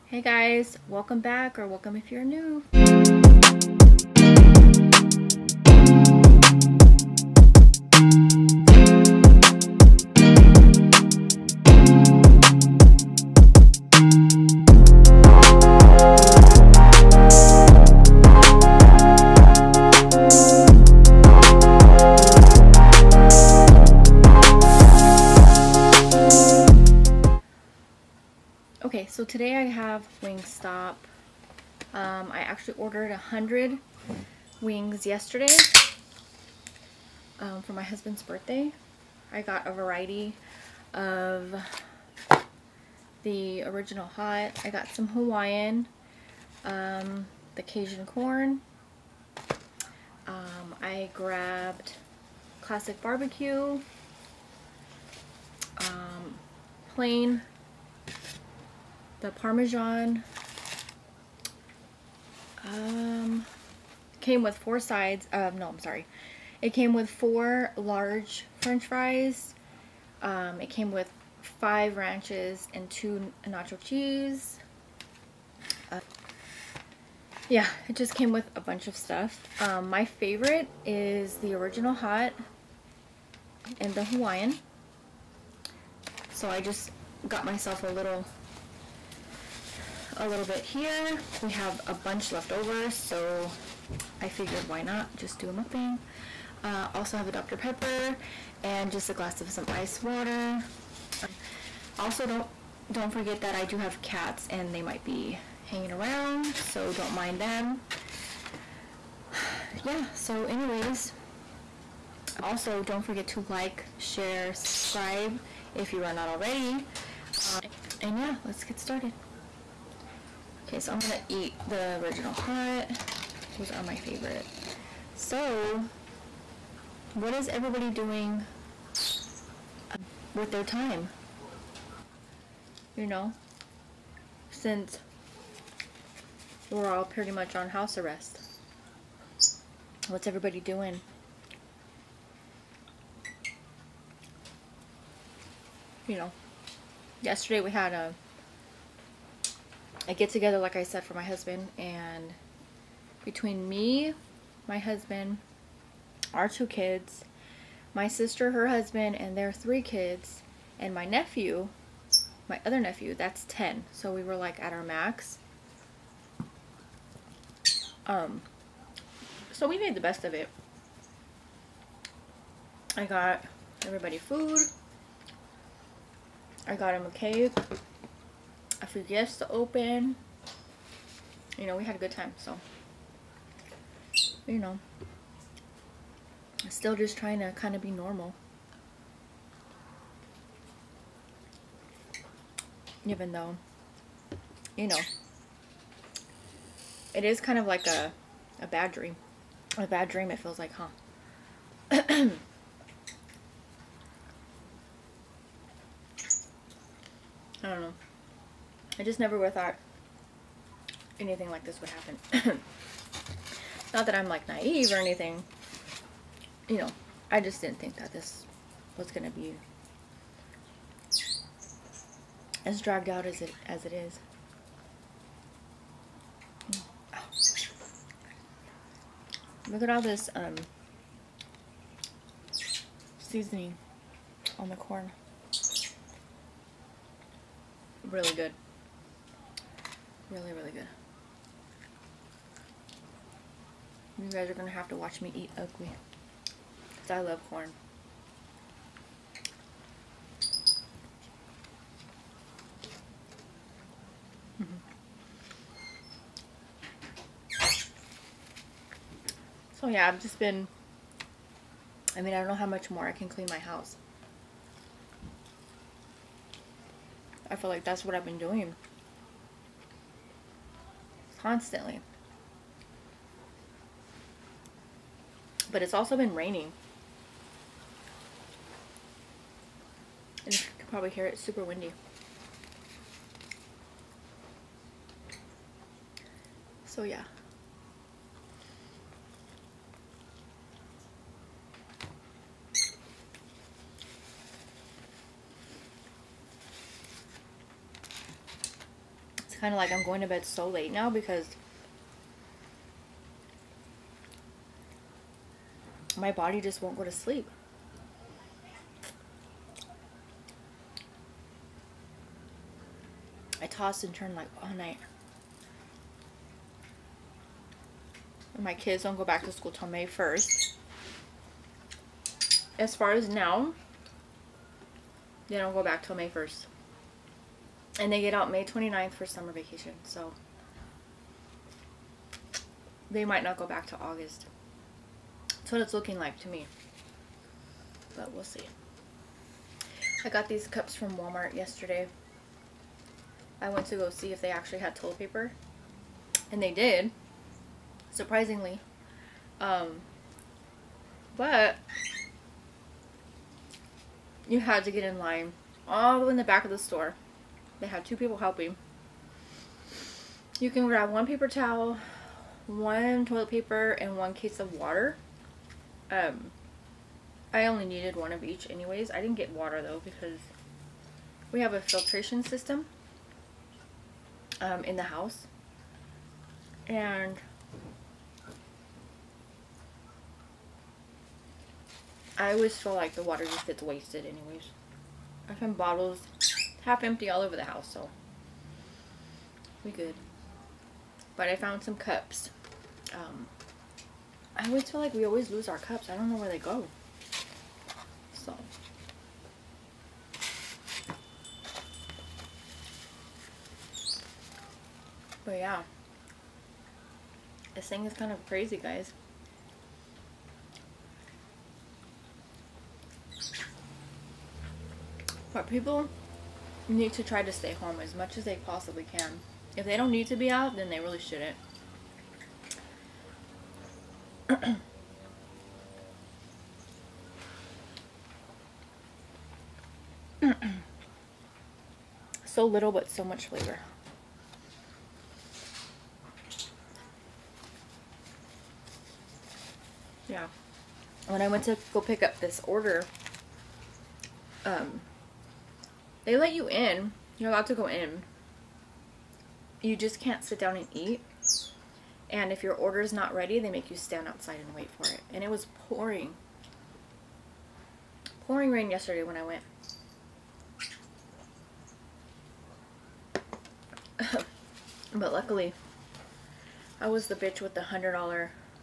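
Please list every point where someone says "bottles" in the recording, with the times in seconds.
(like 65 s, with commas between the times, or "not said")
385 s.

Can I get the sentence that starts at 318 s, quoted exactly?
And my kids don't go back to school till May 1st.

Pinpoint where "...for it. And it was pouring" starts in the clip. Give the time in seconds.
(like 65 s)
454 s.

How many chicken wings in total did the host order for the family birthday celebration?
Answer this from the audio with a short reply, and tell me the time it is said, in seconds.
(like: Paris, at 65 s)
100, at 33 s.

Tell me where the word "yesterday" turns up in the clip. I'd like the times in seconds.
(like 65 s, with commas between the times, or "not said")
35 s, 147 s, 341 s, 458 s.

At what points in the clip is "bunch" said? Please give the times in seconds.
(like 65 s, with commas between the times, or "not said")
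78 s, 91 s.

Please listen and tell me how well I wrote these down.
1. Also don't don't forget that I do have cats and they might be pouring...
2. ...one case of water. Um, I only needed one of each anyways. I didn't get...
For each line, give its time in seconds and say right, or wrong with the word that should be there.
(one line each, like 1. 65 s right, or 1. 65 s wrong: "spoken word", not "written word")
1. 101 s wrong: "hanging", not "pouring"
2. 364 s right.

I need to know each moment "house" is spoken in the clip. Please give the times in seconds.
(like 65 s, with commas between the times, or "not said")
137 s, 263 s, 375 s, 387 s.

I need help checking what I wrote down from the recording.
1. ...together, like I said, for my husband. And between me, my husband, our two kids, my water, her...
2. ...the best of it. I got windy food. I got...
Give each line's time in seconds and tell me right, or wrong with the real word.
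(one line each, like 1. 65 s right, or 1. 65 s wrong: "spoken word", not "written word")
1. 150 s wrong: "sister", not "water"
2. 169 s wrong: "everybody", not "windy".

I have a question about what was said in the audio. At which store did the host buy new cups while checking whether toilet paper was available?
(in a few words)
Walmart.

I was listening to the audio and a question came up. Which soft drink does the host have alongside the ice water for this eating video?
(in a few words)
Dr. Pepper.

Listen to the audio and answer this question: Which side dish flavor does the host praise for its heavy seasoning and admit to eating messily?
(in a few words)
Cajun corn.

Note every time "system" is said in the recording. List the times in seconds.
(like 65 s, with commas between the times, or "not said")
372 s.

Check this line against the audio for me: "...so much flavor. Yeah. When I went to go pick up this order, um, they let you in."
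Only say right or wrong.
right.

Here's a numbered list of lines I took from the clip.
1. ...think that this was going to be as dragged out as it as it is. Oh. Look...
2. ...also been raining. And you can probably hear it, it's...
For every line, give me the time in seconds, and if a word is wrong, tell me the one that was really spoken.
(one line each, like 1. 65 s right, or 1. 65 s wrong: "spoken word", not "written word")
1. 217 s right
2. 275 s right.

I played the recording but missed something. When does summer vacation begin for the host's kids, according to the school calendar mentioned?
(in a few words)
May 29th.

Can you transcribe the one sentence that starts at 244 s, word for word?
You guys are going to have to watch me eat ugly.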